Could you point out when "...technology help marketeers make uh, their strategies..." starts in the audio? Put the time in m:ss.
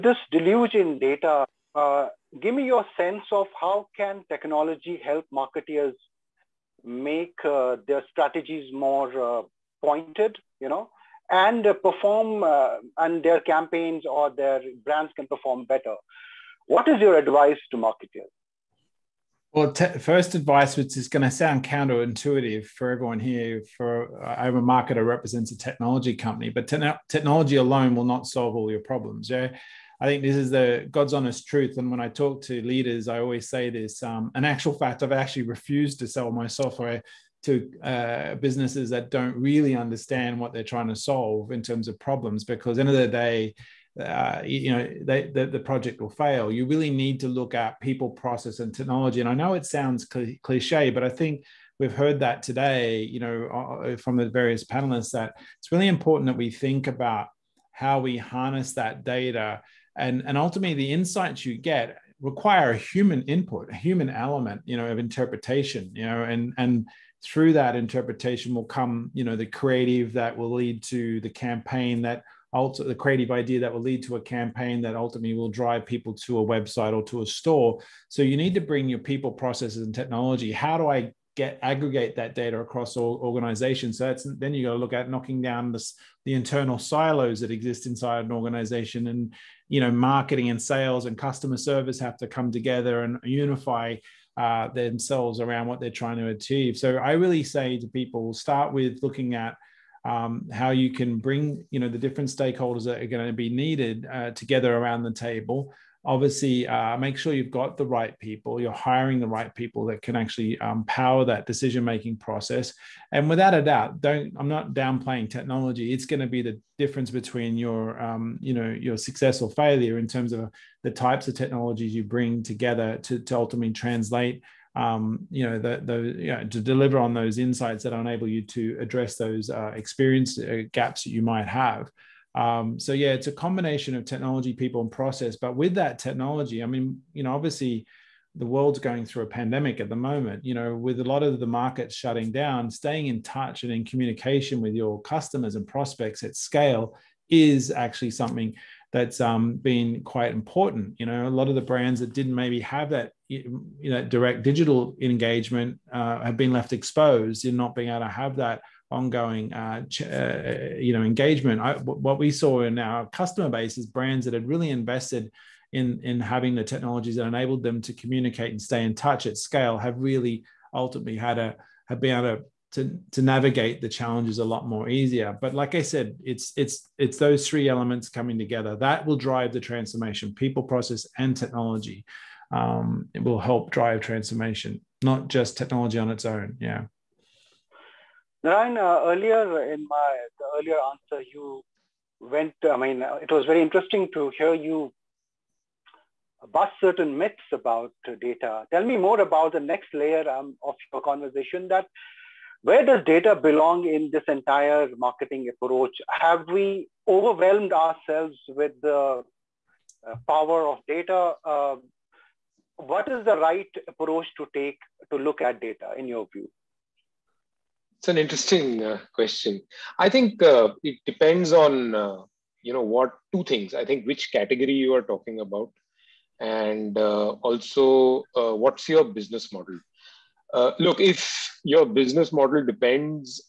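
0:04.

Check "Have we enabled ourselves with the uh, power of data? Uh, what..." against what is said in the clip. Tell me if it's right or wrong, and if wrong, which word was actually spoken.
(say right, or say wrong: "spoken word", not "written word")
wrong: "overwhelmed", not "enabled".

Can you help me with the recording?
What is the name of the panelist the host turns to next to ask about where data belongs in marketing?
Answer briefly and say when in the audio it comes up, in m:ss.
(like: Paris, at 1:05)
Narayan, at 3:08.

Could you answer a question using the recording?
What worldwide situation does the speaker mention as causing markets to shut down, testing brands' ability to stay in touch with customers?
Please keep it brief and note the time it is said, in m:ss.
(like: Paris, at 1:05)
A pandemic, at 2:19.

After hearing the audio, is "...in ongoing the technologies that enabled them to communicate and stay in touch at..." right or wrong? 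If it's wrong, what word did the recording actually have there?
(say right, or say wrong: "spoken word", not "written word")
wrong: "having", not "ongoing".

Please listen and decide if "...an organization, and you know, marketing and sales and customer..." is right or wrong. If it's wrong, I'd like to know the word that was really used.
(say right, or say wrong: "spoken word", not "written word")
right.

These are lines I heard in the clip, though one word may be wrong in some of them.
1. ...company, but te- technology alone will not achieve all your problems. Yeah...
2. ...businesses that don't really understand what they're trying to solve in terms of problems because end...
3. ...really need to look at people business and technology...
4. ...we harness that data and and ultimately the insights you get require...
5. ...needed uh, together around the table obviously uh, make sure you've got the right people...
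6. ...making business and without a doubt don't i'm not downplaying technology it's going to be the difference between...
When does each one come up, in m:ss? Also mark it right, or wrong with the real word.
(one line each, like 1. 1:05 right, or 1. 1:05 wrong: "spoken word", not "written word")
1. 0:26 wrong: "solve", not "achieve"
2. 0:38 right
3. 0:46 wrong: "process", not "business"
4. 0:57 right
5. 1:43 right
6. 1:51 wrong: "process", not "business".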